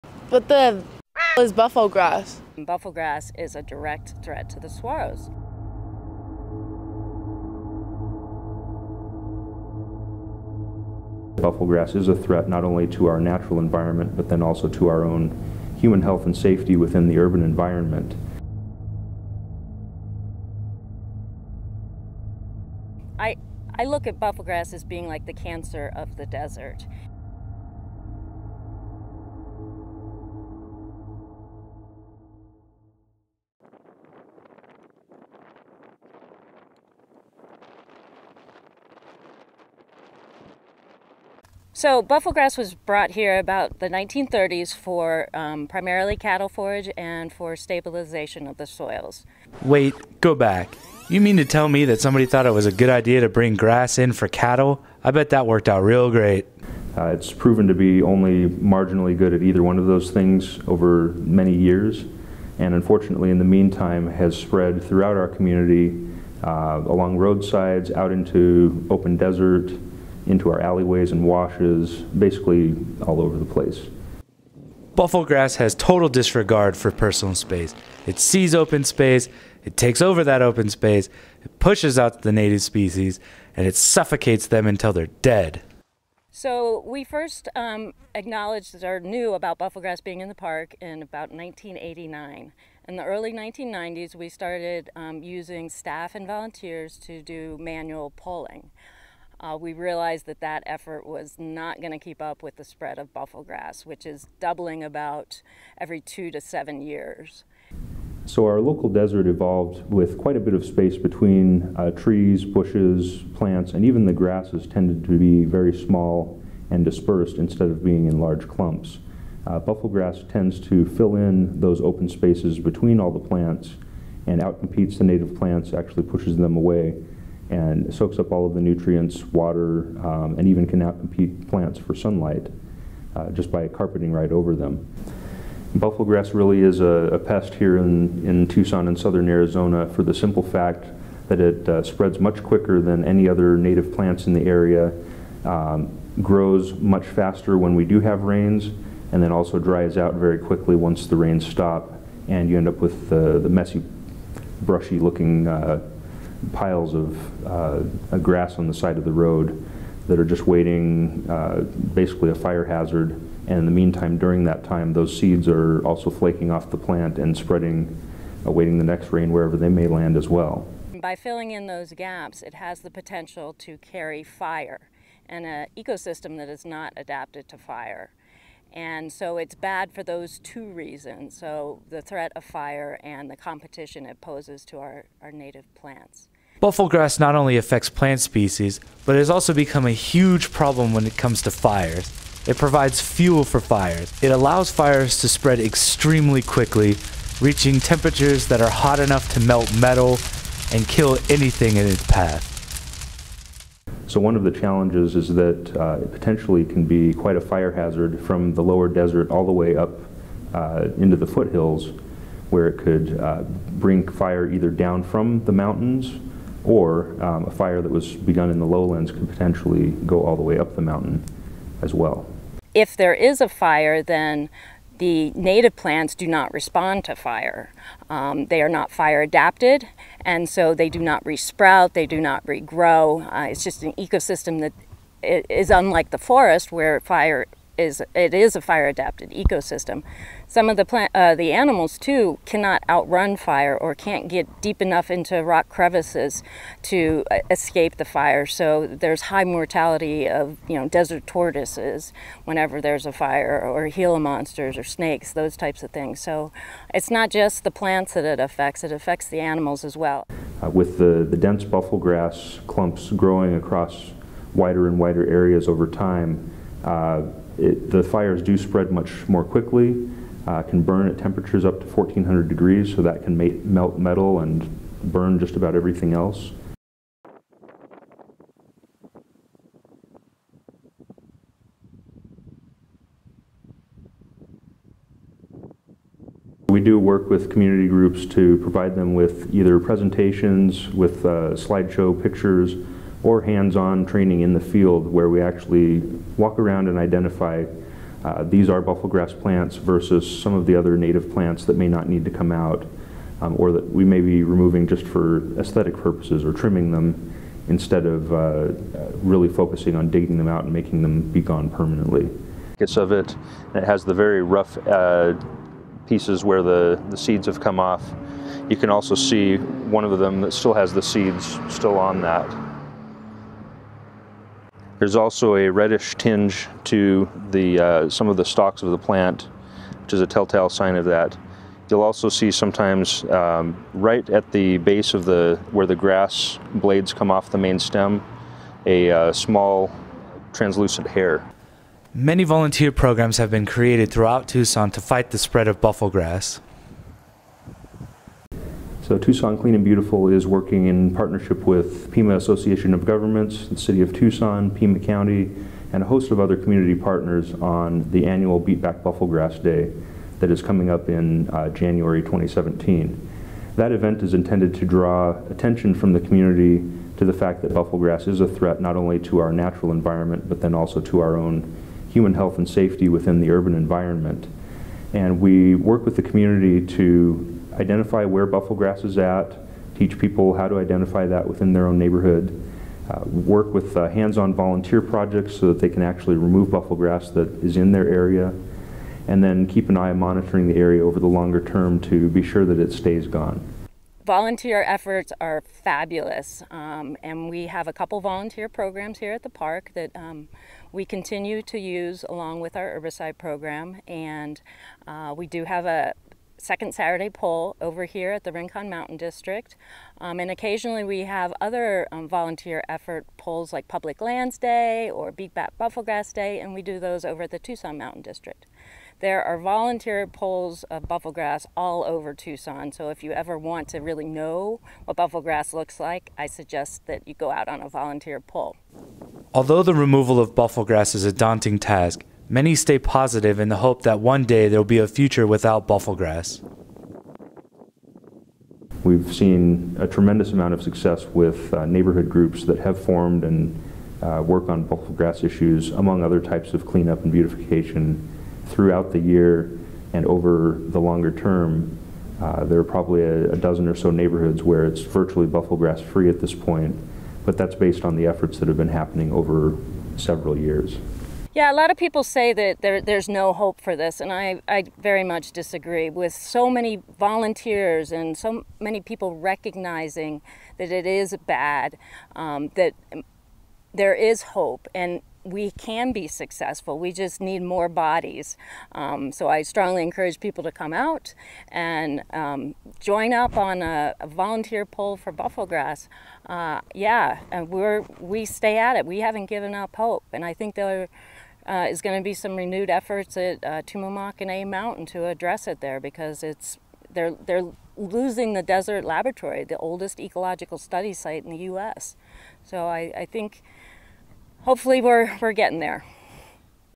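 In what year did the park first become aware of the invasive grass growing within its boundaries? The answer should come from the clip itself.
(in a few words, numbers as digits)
1989.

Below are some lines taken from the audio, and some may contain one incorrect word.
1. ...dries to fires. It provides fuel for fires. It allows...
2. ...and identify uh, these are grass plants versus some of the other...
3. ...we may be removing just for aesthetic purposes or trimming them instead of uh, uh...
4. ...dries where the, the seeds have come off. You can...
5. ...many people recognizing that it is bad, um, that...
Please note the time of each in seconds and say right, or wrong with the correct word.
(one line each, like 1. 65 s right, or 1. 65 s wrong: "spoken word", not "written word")
1. 191 s wrong: "comes", not "dries"
2. 296 s right
3. 303 s right
4. 316 s wrong: "pieces", not "dries"
5. 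468 s right.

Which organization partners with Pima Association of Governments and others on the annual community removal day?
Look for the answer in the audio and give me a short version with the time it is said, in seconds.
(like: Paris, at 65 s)
Tucson Clean and Beautiful, at 349 s.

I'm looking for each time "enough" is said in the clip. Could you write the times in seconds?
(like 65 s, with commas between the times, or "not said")
198 s, 244 s.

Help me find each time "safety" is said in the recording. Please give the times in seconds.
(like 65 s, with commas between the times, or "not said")
16 s, 372 s.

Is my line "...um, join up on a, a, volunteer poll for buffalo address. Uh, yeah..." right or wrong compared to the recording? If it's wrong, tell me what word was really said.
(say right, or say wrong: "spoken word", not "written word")
wrong: "grass", not "address".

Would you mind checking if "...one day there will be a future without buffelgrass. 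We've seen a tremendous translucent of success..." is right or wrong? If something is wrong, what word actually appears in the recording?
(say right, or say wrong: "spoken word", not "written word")
wrong: "amount", not "translucent".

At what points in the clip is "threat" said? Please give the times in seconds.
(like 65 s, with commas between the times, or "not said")
4 s, 12 s, 182 s, 368 s.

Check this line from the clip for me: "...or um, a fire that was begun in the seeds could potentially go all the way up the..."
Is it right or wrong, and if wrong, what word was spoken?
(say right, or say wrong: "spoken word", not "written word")
wrong: "lowlands", not "seeds".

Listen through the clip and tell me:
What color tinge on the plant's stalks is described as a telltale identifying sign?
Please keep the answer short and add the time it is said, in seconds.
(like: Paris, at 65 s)
reddish, at 325 s.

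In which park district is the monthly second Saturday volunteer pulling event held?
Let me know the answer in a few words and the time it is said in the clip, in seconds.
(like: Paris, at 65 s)
Rincon Mountain District, at 408 s.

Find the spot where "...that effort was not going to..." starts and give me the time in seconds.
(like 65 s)
100 s.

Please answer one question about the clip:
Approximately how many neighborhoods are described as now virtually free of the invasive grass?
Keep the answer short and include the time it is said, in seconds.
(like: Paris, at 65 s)
12, at 453 s.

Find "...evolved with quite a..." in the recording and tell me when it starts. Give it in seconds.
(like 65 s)
109 s.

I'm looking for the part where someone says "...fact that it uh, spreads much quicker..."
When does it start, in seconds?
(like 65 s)
140 s.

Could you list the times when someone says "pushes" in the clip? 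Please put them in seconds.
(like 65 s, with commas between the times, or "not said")
81 s, 126 s.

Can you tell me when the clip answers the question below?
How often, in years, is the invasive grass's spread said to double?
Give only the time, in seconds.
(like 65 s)
105 s.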